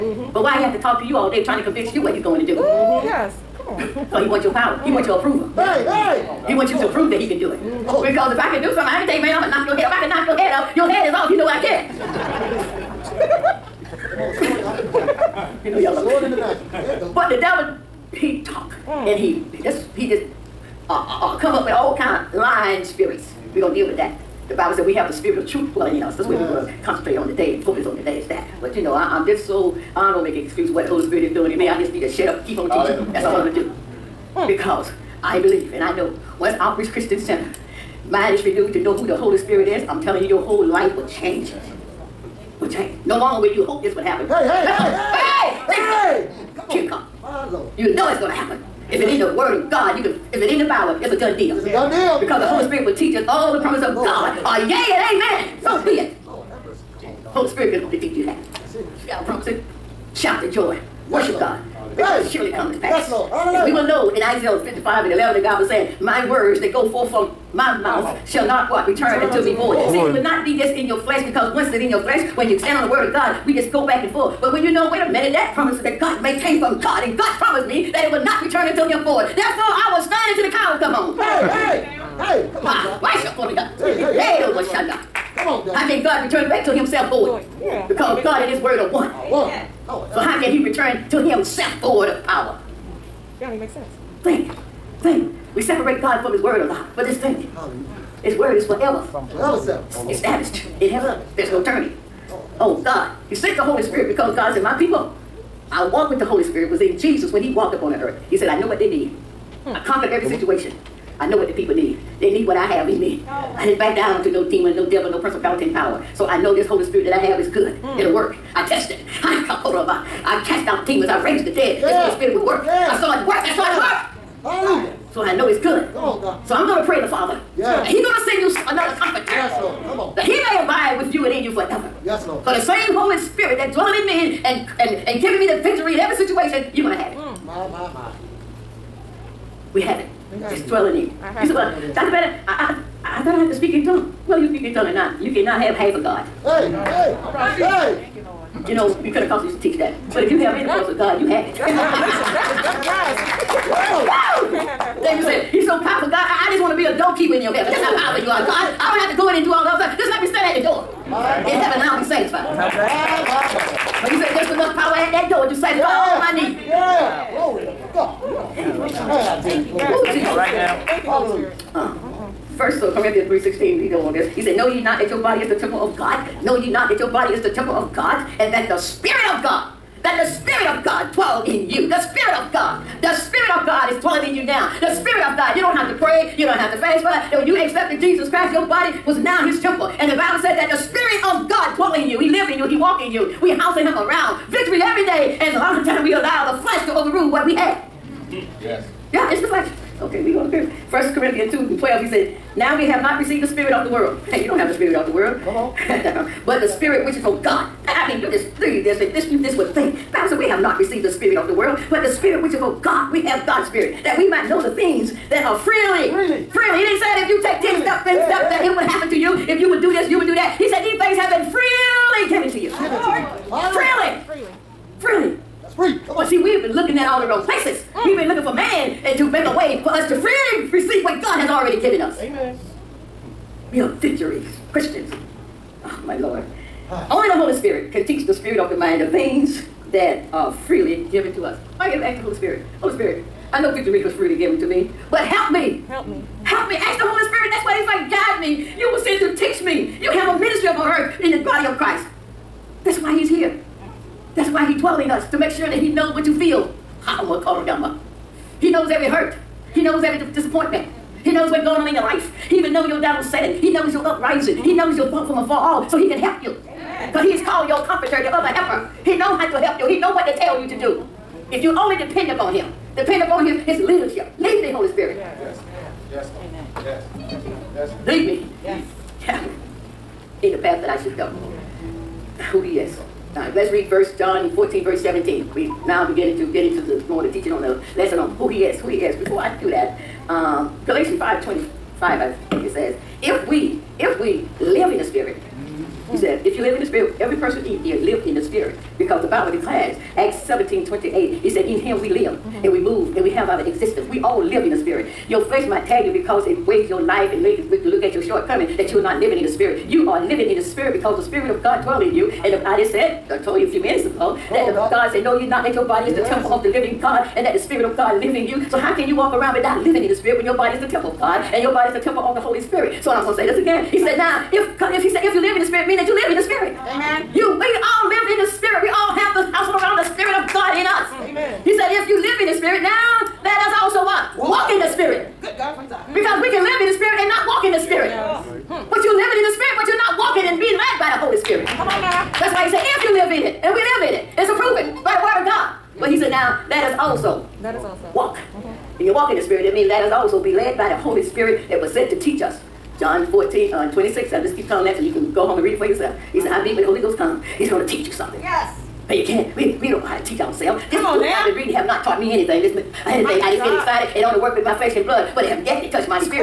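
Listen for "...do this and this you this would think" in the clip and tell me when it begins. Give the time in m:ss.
3:28.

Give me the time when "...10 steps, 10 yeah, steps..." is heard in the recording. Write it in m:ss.
3:37.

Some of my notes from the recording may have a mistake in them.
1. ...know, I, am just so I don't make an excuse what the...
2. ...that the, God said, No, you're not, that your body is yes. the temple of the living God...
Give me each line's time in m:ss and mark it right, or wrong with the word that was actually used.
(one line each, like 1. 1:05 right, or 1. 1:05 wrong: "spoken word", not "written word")
1. 0:28 right
2. 5:14 right.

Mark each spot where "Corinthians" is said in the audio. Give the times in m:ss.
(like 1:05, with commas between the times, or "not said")
2:52, 3:21.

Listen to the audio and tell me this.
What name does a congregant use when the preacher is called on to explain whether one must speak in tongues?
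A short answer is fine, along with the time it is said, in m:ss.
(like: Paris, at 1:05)
Dr. Bennett, at 2:21.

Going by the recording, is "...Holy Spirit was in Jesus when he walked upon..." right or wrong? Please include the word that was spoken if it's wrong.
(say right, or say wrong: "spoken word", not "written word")
right.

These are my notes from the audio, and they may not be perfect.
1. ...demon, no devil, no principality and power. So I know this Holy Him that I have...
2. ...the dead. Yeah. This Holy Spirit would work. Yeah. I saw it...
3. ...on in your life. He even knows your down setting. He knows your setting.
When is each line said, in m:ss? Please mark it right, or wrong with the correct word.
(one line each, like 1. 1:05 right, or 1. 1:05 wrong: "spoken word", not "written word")
1. 1:54 wrong: "Spirit", not "Him"
2. 2:01 right
3. 4:21 wrong: "uprising", not "setting".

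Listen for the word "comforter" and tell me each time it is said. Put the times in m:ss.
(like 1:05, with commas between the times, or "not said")
2:08, 4:27.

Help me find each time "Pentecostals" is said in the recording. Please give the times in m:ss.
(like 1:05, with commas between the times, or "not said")
2:29.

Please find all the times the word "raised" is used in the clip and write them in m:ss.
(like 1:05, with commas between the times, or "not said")
2:01.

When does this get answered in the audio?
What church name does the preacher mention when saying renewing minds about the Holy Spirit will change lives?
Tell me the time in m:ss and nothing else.
0:36.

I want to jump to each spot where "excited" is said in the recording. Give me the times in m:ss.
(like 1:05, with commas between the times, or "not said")
6:03.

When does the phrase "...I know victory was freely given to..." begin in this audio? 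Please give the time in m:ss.
4:03.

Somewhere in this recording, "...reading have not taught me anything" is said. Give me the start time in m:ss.
6:01.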